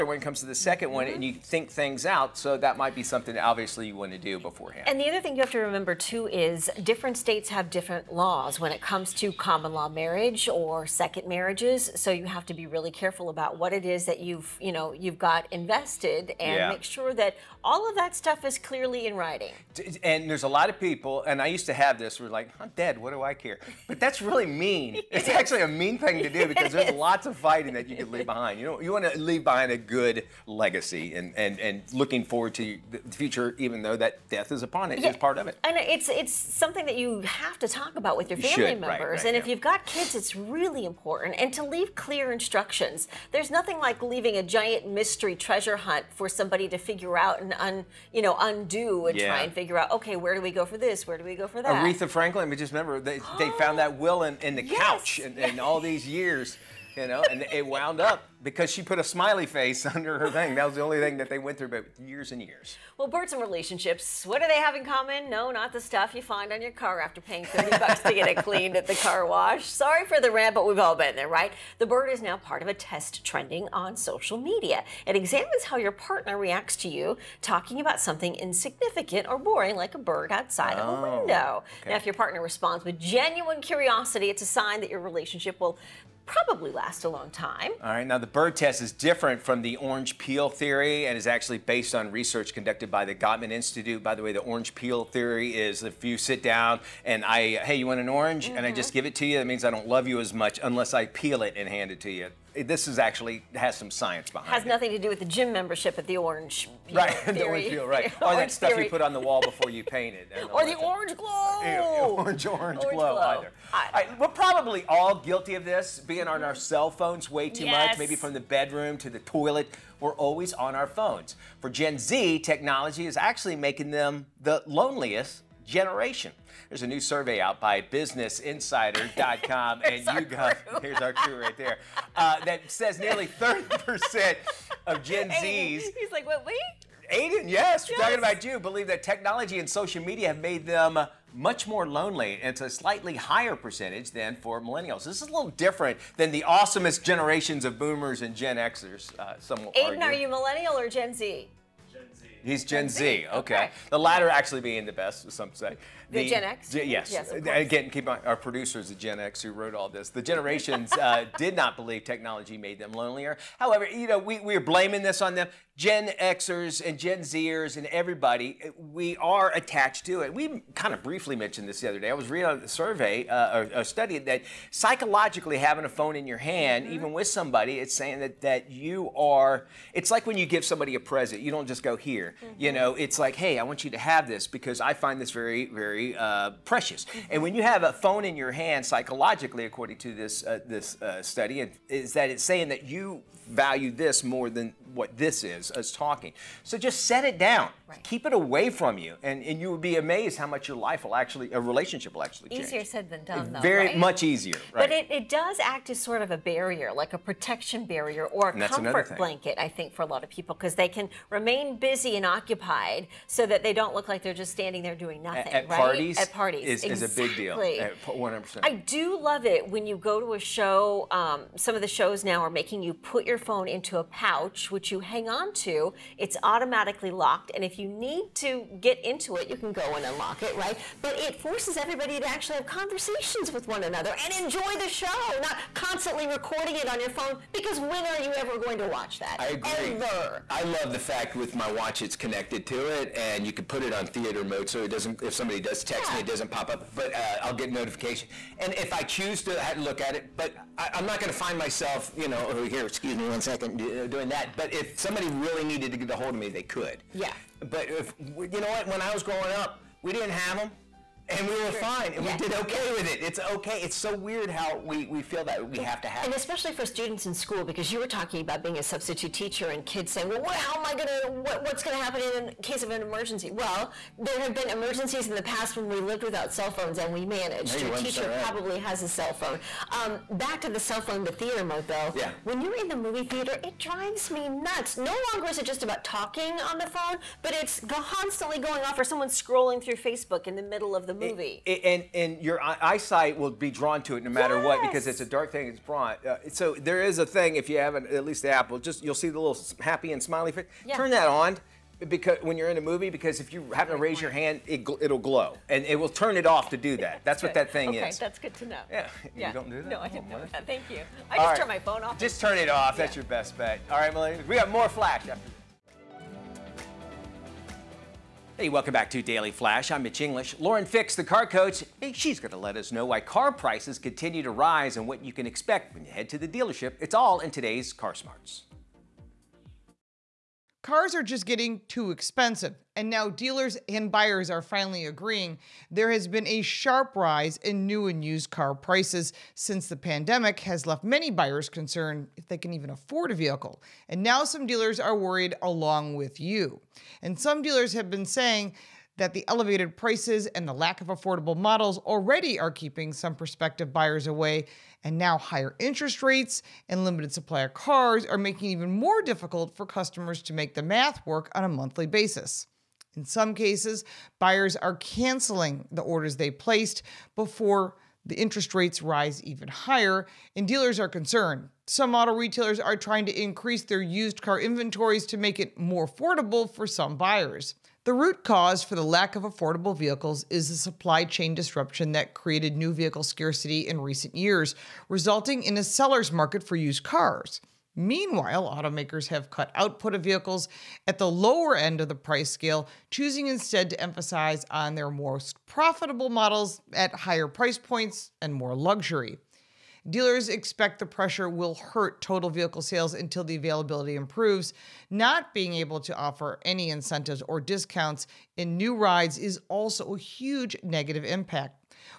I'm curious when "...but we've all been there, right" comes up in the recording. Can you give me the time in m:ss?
1:10.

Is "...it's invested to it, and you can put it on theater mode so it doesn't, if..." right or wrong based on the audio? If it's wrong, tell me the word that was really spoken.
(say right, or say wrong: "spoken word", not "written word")
wrong: "connected", not "invested".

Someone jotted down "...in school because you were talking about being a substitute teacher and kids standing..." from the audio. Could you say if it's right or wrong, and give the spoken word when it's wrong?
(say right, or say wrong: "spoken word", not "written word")
wrong: "saying", not "standing".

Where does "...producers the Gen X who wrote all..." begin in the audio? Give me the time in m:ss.
2:38.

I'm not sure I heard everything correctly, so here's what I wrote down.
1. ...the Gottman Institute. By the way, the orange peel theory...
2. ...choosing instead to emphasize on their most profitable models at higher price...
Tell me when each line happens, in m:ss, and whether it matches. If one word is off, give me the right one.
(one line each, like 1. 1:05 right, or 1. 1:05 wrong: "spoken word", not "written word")
1. 1:33 right
2. 6:33 right.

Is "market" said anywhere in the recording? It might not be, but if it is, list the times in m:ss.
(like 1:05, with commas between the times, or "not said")
6:26.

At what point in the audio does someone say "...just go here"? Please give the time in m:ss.
3:01.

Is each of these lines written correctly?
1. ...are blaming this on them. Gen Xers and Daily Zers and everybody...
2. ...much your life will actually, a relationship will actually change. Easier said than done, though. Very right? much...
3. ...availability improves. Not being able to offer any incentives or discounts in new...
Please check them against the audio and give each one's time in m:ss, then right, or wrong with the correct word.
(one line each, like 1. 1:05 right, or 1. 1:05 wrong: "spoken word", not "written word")
1. 2:44 wrong: "Gen", not "Daily"
2. 3:20 right
3. 6:43 right.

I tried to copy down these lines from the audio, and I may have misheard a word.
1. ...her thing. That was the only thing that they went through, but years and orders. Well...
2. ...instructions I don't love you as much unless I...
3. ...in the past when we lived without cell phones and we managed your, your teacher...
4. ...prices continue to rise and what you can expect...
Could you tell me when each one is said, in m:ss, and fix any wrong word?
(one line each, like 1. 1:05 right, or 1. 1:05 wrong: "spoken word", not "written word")
1. 1:00 wrong: "years", not "orders"
2. 1:39 wrong: "means", not "instructions"
3. 4:35 right
4. 5:23 right.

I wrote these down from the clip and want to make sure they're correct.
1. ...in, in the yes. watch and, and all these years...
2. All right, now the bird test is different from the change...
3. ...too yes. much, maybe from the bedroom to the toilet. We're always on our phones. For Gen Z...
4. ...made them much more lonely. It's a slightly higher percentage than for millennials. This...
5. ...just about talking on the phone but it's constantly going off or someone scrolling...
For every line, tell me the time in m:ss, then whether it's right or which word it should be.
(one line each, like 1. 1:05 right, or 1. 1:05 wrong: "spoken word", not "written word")
1. 0:54 wrong: "couch", not "watch"
2. 1:27 wrong: "orange", not "change"
3. 1:57 right
4. 2:20 right
5. 4:45 right.